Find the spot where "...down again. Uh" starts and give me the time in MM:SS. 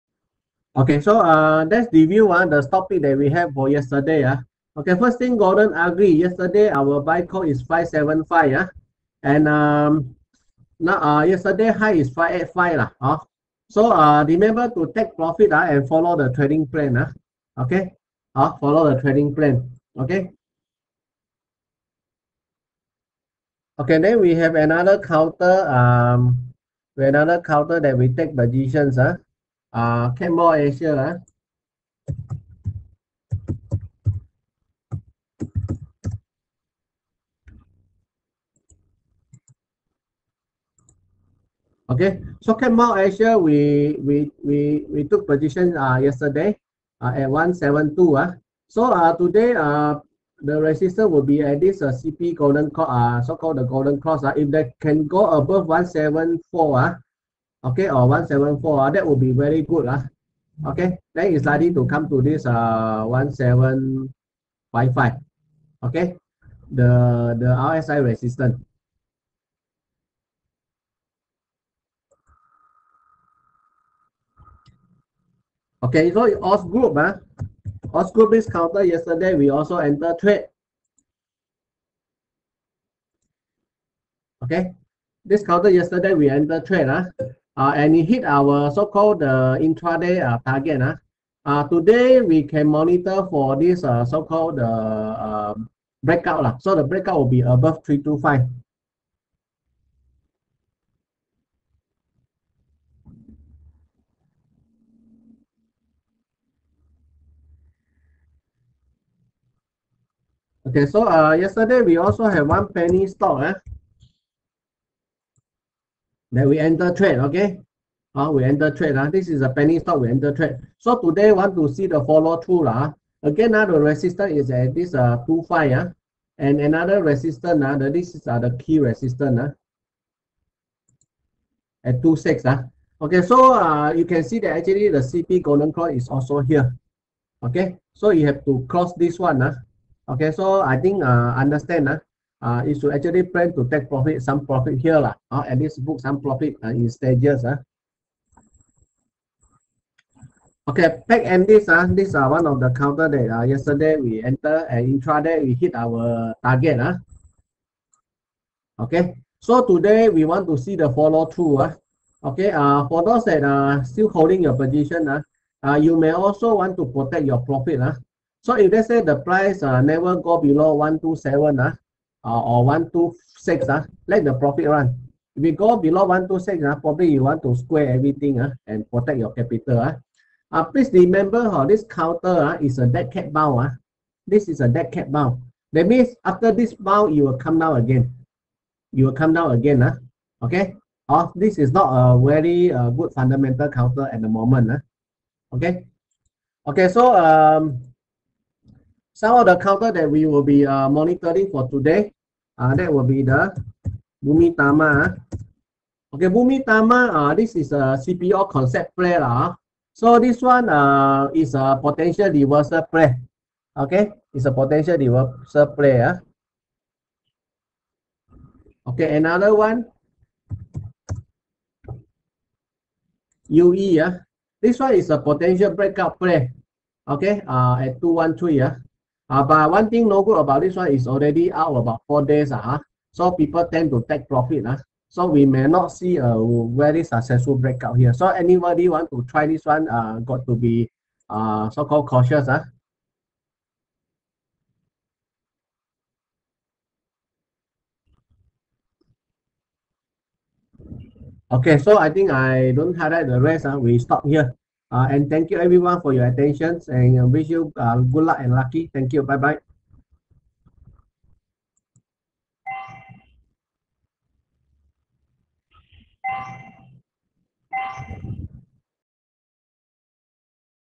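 03:09.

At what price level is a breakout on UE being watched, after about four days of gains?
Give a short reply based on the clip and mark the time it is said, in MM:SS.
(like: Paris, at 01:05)
213, at 03:48.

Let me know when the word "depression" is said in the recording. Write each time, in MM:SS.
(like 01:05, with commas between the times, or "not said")
not said.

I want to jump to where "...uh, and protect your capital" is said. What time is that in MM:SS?
02:58.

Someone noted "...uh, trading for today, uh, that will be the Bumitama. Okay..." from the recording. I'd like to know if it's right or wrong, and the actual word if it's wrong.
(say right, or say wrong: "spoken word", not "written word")
wrong: "monitoring", not "trading".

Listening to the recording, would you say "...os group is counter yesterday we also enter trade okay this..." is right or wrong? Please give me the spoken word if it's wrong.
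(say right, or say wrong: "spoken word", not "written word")
right.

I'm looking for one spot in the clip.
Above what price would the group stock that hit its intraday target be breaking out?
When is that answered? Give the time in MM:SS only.
01:37.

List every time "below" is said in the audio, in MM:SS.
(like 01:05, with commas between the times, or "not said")
02:50, 02:55.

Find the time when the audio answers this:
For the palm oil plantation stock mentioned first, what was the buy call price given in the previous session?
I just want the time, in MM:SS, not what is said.
00:07.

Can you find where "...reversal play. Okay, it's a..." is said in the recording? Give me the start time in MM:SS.
03:32.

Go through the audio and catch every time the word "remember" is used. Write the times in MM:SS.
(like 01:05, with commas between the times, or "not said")
00:14, 03:00.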